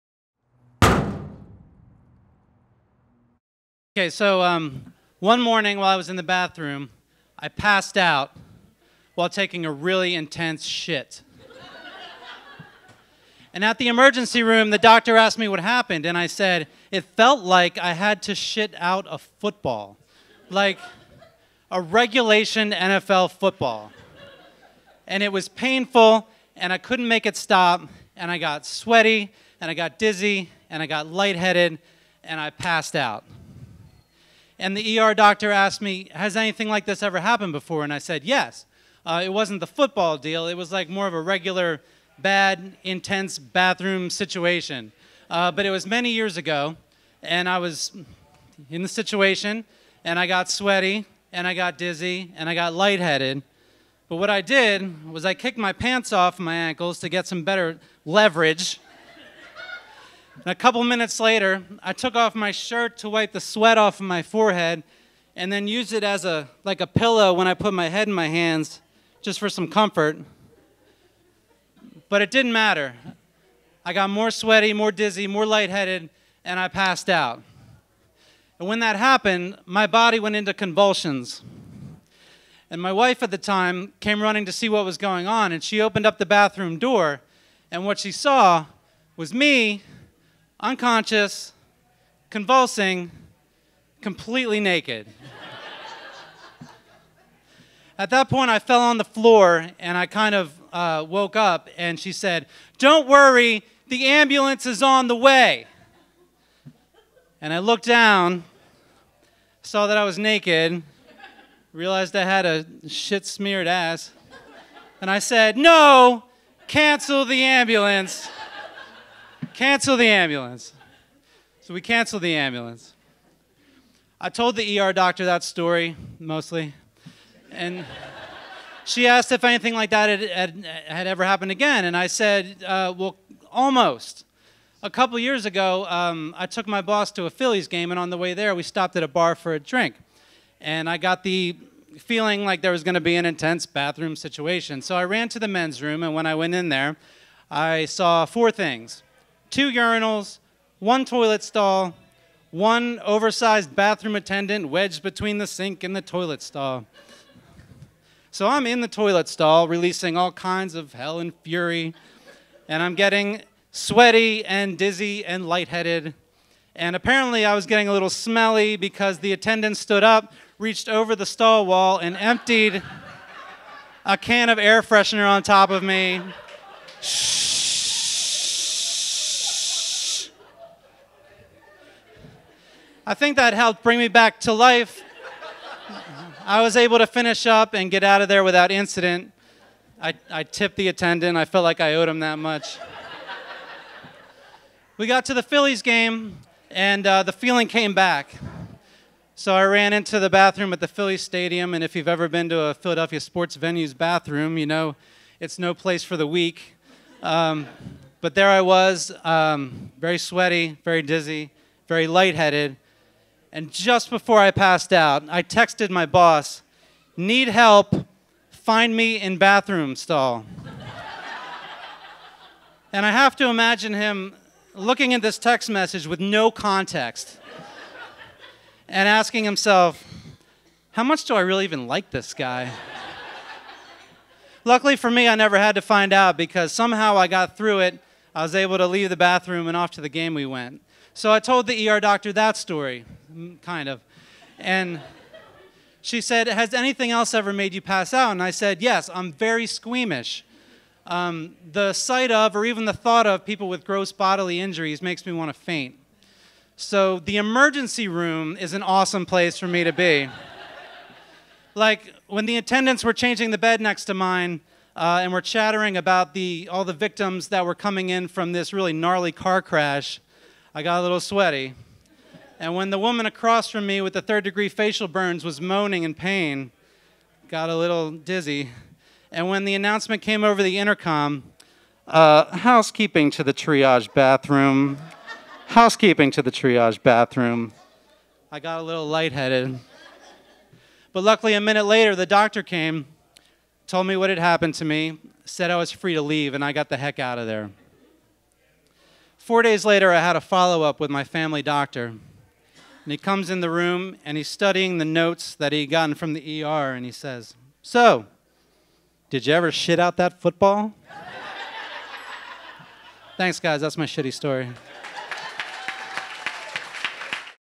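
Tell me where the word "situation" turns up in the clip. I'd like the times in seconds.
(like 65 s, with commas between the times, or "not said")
44 s, 48 s, 144 s.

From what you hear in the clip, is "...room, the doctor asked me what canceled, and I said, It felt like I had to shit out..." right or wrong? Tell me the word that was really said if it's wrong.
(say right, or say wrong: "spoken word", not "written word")
wrong: "happened", not "canceled".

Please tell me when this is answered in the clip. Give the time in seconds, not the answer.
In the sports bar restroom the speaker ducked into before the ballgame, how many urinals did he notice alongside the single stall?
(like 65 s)
149 s.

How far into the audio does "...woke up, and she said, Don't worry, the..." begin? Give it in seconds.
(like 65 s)
101 s.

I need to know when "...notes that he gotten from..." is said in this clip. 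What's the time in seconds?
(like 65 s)
305 s.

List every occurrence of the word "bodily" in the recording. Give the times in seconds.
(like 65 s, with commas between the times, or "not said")
254 s.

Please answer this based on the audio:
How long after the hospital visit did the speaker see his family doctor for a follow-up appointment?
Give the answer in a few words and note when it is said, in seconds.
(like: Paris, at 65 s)
4 days, at 299 s.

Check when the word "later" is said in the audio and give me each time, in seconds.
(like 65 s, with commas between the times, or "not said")
61 s, 291 s, 299 s.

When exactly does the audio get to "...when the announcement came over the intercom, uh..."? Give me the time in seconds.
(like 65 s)
279 s.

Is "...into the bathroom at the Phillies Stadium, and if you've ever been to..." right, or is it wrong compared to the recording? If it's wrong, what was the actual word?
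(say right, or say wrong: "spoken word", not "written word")
right.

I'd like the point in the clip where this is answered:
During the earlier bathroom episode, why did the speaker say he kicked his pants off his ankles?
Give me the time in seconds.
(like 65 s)
57 s.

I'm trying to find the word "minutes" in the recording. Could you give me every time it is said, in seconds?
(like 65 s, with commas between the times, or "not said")
60 s, 291 s.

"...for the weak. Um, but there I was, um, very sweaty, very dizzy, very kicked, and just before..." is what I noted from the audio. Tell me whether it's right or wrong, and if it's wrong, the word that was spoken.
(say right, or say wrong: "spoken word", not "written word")
wrong: "lightheaded", not "kicked".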